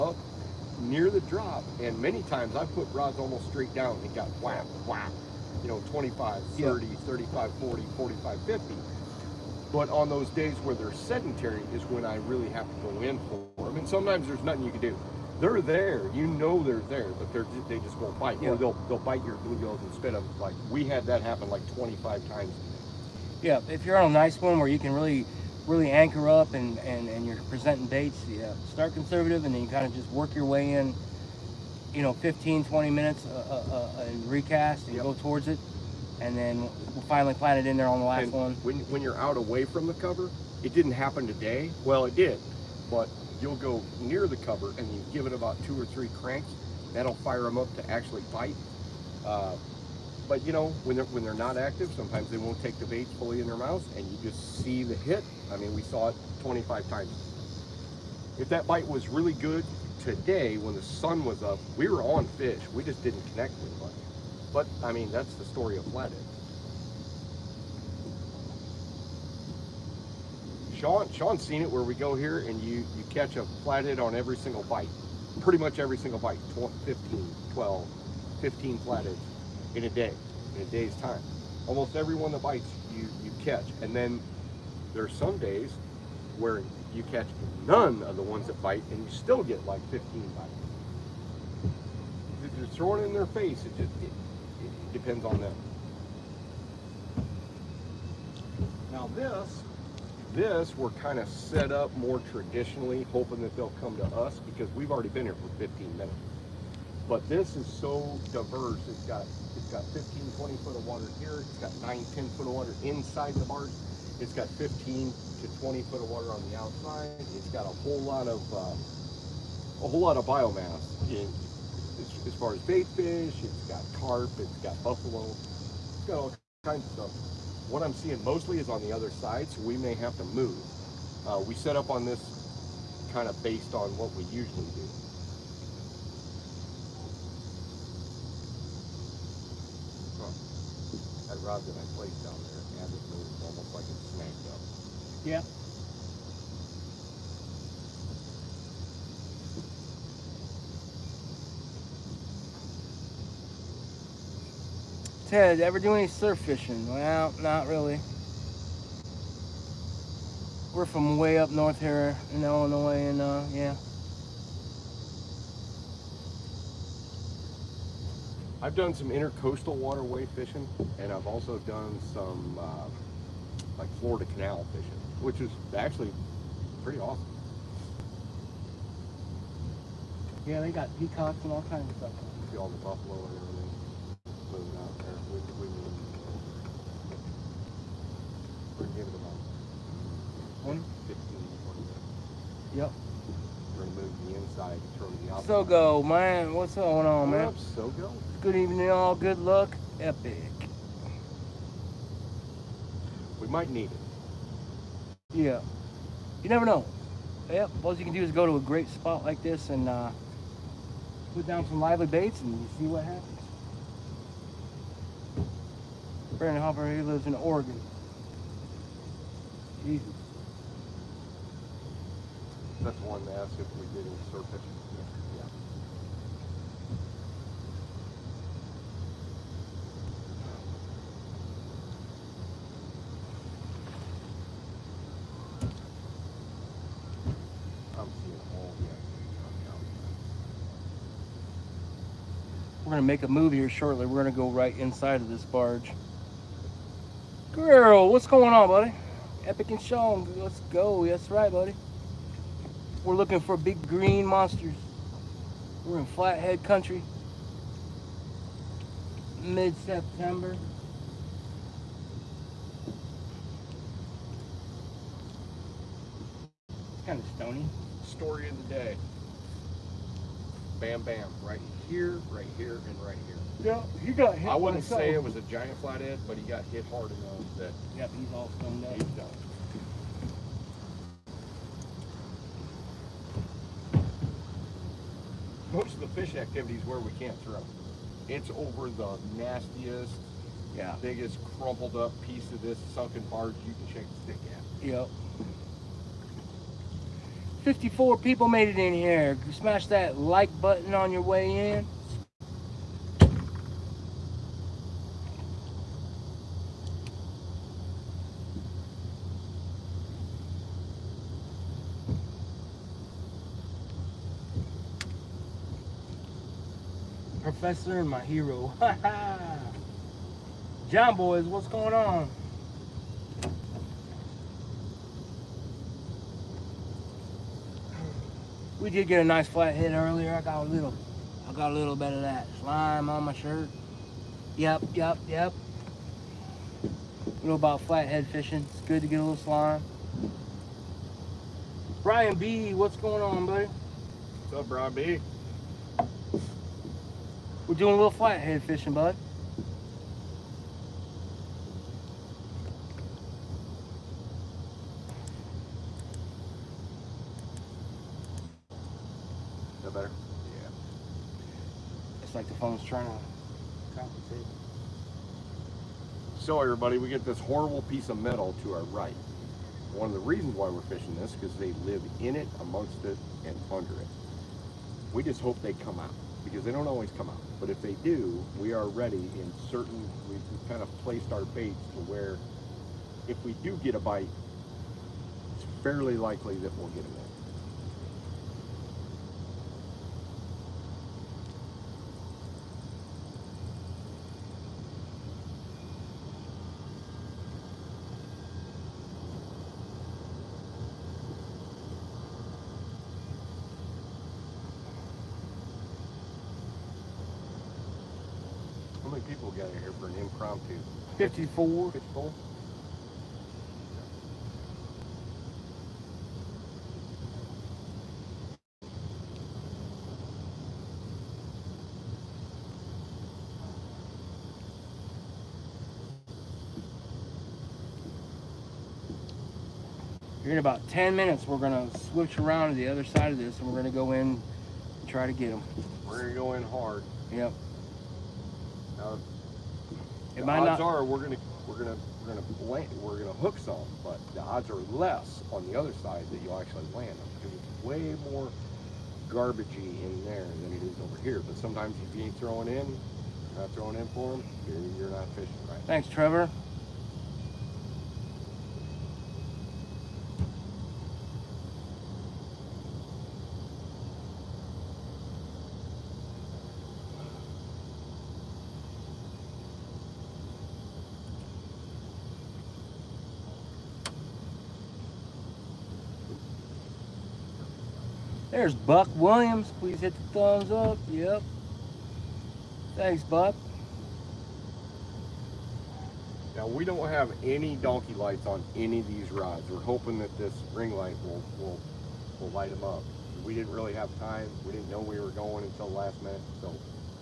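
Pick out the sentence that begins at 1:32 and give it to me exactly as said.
If you're throwing in their face, it just it, it depends on them.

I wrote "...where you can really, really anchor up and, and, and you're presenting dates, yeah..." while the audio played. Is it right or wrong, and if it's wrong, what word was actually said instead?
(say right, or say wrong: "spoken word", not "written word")
right.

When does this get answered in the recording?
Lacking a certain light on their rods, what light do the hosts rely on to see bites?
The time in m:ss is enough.
8:10.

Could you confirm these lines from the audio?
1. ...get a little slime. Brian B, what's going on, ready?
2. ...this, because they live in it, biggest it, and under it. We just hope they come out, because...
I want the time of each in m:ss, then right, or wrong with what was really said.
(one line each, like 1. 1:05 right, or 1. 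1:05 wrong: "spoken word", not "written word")
1. 5:39 wrong: "buddy", not "ready"
2. 6:11 wrong: "amongst", not "biggest".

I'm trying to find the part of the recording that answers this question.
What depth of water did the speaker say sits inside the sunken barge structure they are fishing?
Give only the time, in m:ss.
1:51.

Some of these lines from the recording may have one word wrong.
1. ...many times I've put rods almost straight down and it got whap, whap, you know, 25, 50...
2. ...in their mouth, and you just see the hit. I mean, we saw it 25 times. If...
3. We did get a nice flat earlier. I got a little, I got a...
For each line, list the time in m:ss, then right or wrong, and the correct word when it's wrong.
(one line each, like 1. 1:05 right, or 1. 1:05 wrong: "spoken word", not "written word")
1. 0:02 wrong: "30", not "50"
2. 0:53 right
3. 5:28 right.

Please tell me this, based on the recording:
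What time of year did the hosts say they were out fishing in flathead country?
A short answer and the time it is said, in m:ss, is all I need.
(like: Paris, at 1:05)
Mid-September, at 4:19.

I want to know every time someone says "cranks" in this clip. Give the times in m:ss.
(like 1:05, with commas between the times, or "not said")
0:46.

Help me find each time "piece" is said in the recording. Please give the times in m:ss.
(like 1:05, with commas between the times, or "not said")
4:52, 6:07.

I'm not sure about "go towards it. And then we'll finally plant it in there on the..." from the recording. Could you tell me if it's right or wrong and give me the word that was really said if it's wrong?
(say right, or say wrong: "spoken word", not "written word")
right.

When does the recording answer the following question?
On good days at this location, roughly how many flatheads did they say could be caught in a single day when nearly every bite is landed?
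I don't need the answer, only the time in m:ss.
1:17.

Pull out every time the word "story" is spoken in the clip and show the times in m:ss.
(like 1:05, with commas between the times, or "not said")
1:05, 4:28.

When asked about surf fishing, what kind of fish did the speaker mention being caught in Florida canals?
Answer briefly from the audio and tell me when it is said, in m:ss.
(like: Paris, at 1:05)
Peacocks, at 3:00.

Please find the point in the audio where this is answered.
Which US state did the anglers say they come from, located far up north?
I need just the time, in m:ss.
2:42.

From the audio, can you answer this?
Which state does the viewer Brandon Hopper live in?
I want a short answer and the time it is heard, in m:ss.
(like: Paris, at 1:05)
Oregon, at 3:37.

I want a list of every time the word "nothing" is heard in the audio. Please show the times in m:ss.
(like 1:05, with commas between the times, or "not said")
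0:14.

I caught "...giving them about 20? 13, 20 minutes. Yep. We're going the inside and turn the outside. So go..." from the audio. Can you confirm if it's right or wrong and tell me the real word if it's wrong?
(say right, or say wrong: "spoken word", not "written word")
wrong: "15", not "13".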